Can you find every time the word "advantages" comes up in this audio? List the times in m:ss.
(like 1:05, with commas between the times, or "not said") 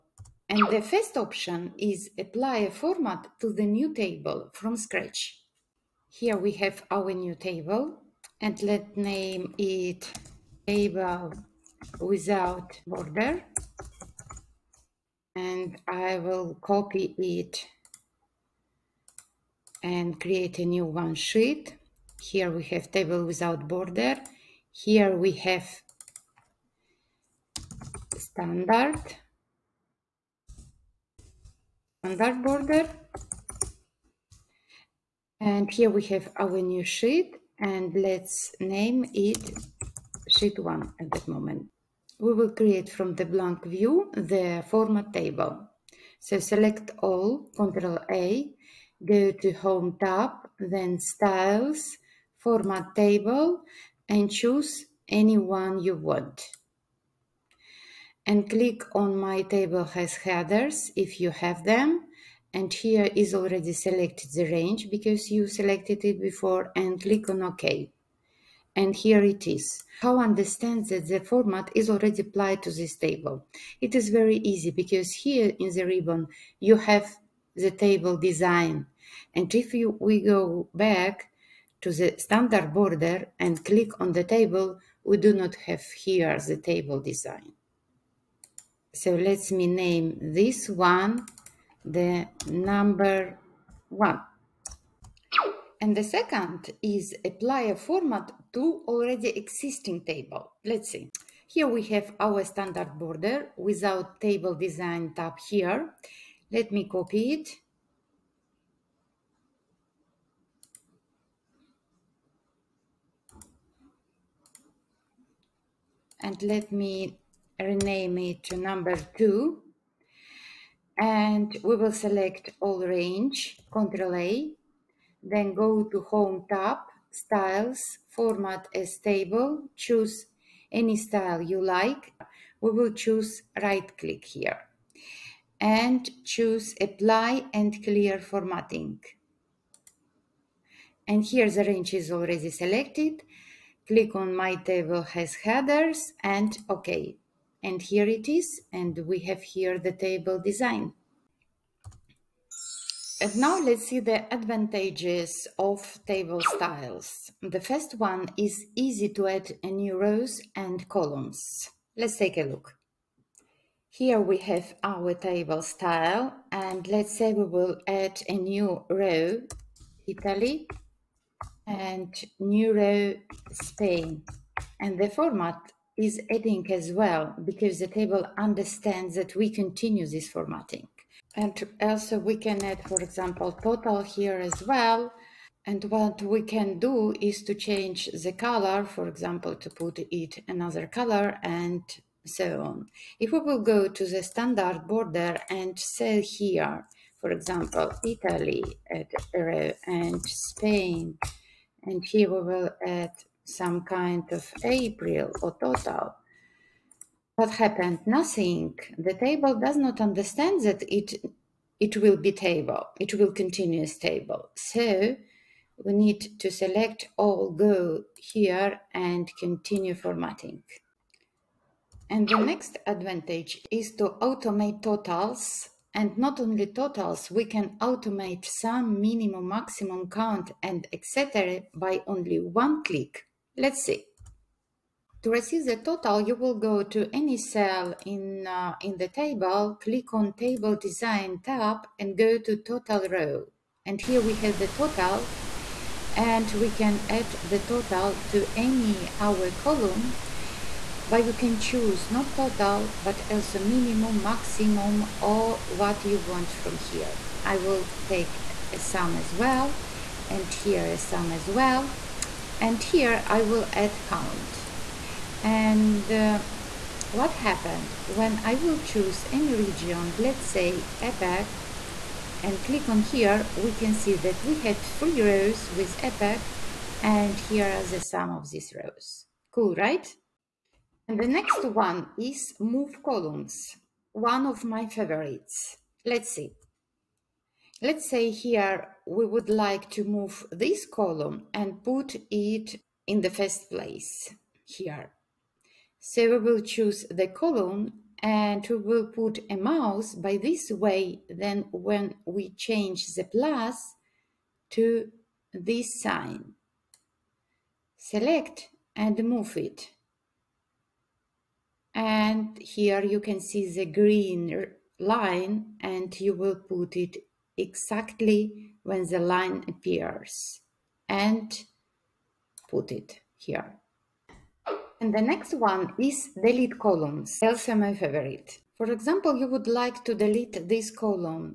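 2:34, 3:42.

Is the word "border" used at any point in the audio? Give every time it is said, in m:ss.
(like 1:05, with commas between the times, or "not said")
0:12, 0:23, 0:32, 1:22, 1:42, 3:14.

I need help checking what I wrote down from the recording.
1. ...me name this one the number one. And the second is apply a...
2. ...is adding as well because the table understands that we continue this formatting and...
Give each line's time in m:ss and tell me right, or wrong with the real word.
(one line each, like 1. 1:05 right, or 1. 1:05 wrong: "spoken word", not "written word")
1. 1:29 right
2. 2:55 right.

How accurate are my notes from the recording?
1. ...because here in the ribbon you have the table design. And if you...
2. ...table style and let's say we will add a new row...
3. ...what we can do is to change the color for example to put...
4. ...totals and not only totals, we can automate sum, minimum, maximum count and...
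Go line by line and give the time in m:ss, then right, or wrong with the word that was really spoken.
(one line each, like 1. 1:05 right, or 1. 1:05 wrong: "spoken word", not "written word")
1. 1:14 right
2. 2:45 right
3. 3:05 right
4. 3:44 right.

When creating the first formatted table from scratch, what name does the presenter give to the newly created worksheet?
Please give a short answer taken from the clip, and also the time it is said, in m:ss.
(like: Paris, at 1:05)
Sheet one, at 0:40.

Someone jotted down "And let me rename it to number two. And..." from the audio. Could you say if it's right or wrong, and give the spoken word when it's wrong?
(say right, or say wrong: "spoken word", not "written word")
right.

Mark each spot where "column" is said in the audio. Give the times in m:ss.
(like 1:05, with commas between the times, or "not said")
2:40, 4:09, 4:43, 4:50, 4:57, 5:26, 5:30.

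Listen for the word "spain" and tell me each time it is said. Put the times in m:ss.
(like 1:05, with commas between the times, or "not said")
2:53, 3:20.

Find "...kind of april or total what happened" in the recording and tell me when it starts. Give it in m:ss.
3:23.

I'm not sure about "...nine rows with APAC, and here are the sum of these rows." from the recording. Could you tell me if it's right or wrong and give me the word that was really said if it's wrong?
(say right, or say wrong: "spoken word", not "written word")
wrong: "three", not "nine".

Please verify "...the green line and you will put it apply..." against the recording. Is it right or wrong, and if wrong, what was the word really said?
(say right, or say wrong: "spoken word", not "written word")
wrong: "exactly", not "apply".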